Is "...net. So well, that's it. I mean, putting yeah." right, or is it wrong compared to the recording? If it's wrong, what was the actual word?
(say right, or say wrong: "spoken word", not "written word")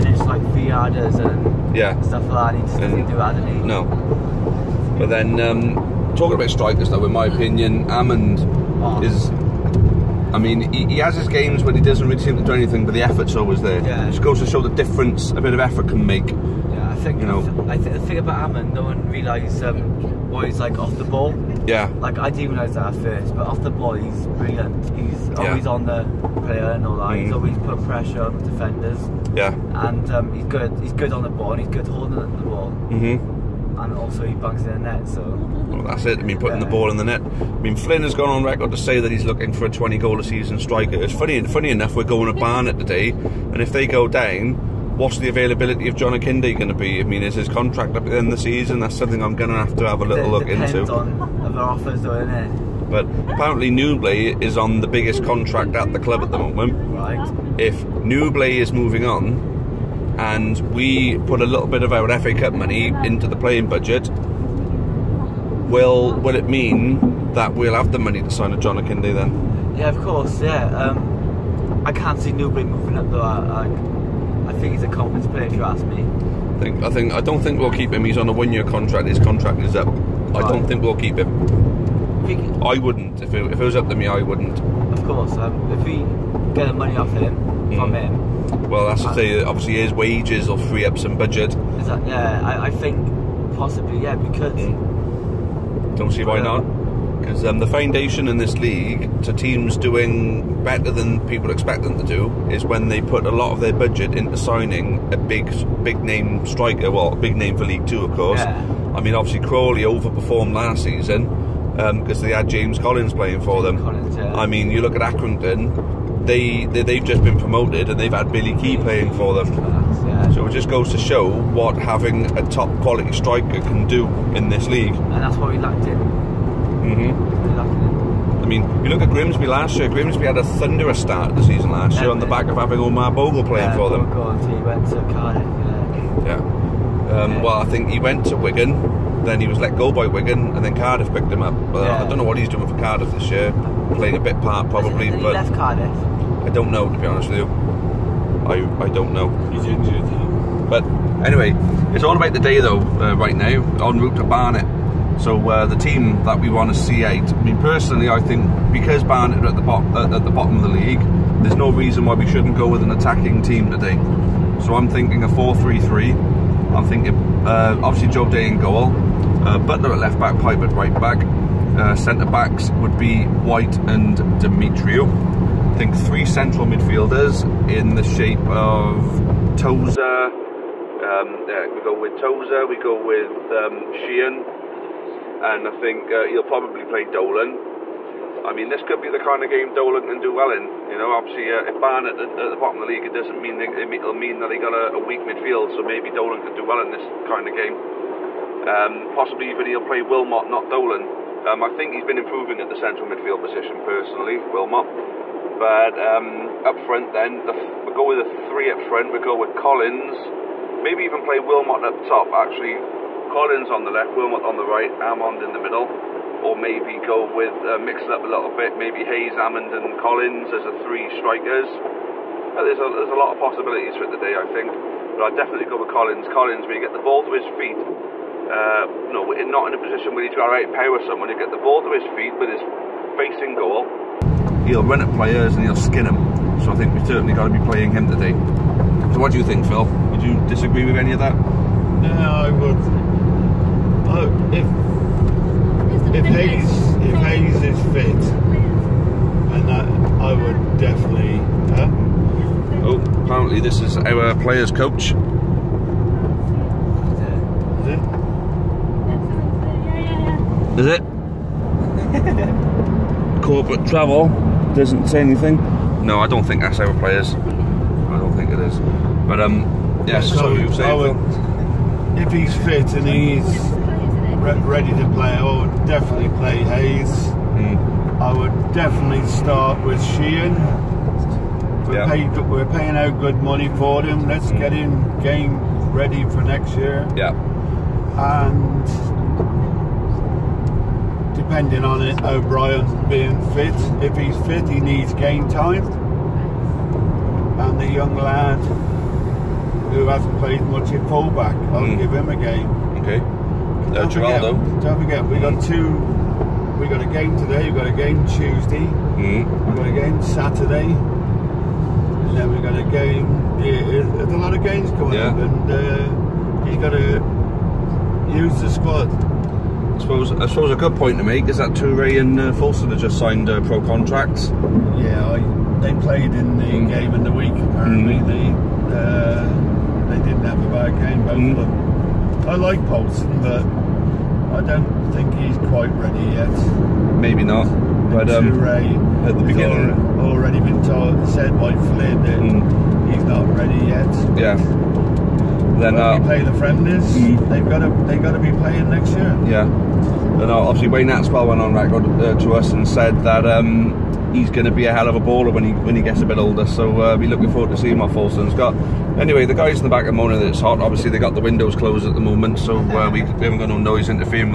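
right.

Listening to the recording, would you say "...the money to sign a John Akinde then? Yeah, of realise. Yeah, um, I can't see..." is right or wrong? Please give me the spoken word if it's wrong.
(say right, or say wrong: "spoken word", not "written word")
wrong: "course", not "realise".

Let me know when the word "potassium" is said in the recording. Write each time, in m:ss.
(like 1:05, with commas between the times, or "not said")
not said.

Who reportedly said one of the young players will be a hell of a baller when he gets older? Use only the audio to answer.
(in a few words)
Wayne Hatswell.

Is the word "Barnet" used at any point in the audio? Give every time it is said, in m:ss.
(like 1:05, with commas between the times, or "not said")
0:42, 2:34, 2:39, 3:11.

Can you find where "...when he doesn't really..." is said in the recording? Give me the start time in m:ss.
0:11.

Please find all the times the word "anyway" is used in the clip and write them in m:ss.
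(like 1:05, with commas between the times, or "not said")
2:31, 5:59.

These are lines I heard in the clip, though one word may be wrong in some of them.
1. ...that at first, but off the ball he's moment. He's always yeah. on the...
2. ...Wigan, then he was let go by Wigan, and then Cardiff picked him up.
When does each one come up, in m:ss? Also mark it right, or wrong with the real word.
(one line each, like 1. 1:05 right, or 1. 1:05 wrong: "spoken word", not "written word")
1. 0:22 wrong: "brilliant", not "moment"
2. 2:18 right.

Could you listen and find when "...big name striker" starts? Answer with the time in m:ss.
1:45.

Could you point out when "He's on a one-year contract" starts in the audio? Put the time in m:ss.
1:18.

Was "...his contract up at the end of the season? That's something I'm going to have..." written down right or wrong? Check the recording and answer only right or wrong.
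right.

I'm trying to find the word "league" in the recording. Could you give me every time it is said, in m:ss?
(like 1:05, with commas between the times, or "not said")
1:38, 1:47, 2:04, 2:40, 3:12.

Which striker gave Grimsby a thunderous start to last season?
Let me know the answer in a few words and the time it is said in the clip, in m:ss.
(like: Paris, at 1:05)
Omar Bogle, at 2:12.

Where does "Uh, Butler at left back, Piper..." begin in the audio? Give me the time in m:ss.
2:49.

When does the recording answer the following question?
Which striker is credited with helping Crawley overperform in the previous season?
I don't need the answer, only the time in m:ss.
1:52.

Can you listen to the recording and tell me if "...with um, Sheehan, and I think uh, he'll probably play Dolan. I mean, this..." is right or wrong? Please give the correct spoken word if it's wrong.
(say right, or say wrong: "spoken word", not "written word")
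right.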